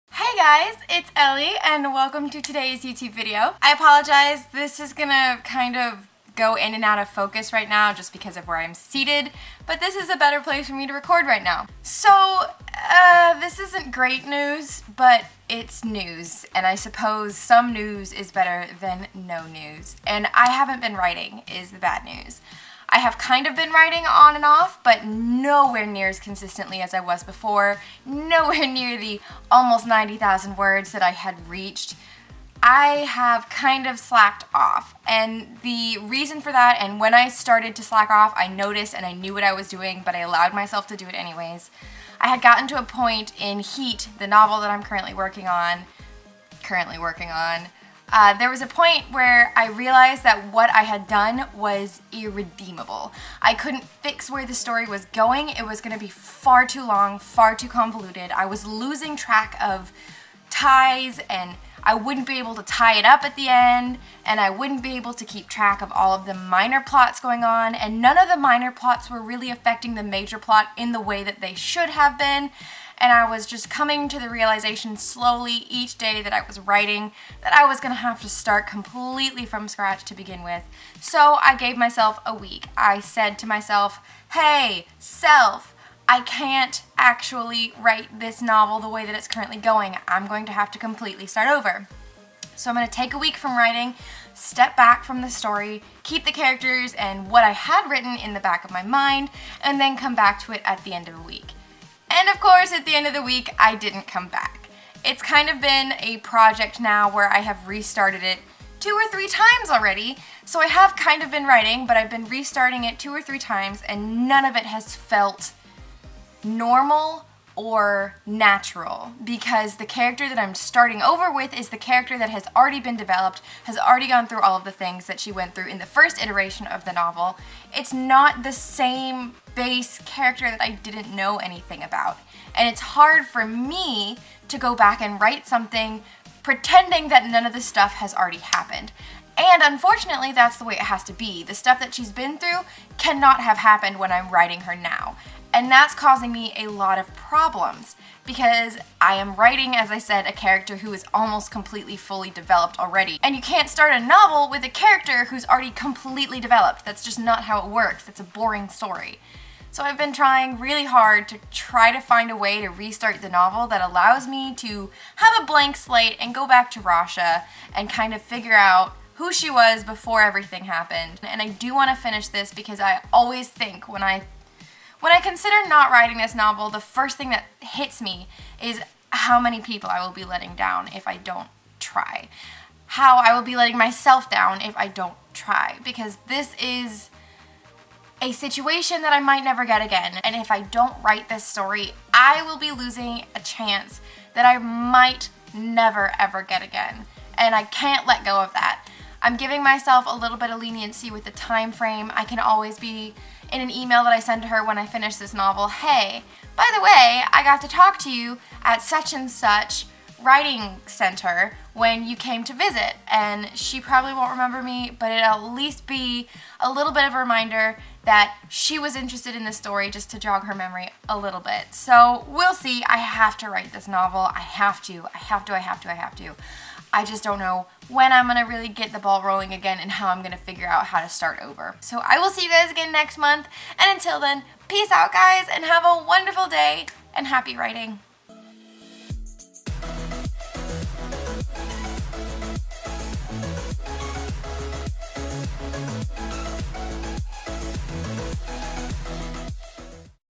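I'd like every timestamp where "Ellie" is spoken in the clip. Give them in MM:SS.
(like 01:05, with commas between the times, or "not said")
00:01.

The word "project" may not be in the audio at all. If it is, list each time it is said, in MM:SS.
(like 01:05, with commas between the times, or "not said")
01:46.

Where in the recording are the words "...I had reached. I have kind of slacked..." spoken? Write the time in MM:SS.
00:31.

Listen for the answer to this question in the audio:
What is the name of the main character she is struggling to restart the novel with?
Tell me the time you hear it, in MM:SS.
02:46.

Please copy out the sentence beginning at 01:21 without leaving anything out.
So I gave myself a week.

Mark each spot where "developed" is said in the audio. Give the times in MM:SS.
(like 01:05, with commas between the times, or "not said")
02:02, 02:32, 02:36.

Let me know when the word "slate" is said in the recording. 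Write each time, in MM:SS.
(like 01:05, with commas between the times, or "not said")
02:45.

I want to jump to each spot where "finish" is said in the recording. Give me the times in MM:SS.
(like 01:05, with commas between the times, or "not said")
02:52, 03:24.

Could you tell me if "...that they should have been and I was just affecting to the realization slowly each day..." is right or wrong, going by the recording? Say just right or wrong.
wrong.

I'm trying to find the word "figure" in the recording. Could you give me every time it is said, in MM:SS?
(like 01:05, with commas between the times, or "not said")
02:48, 03:50.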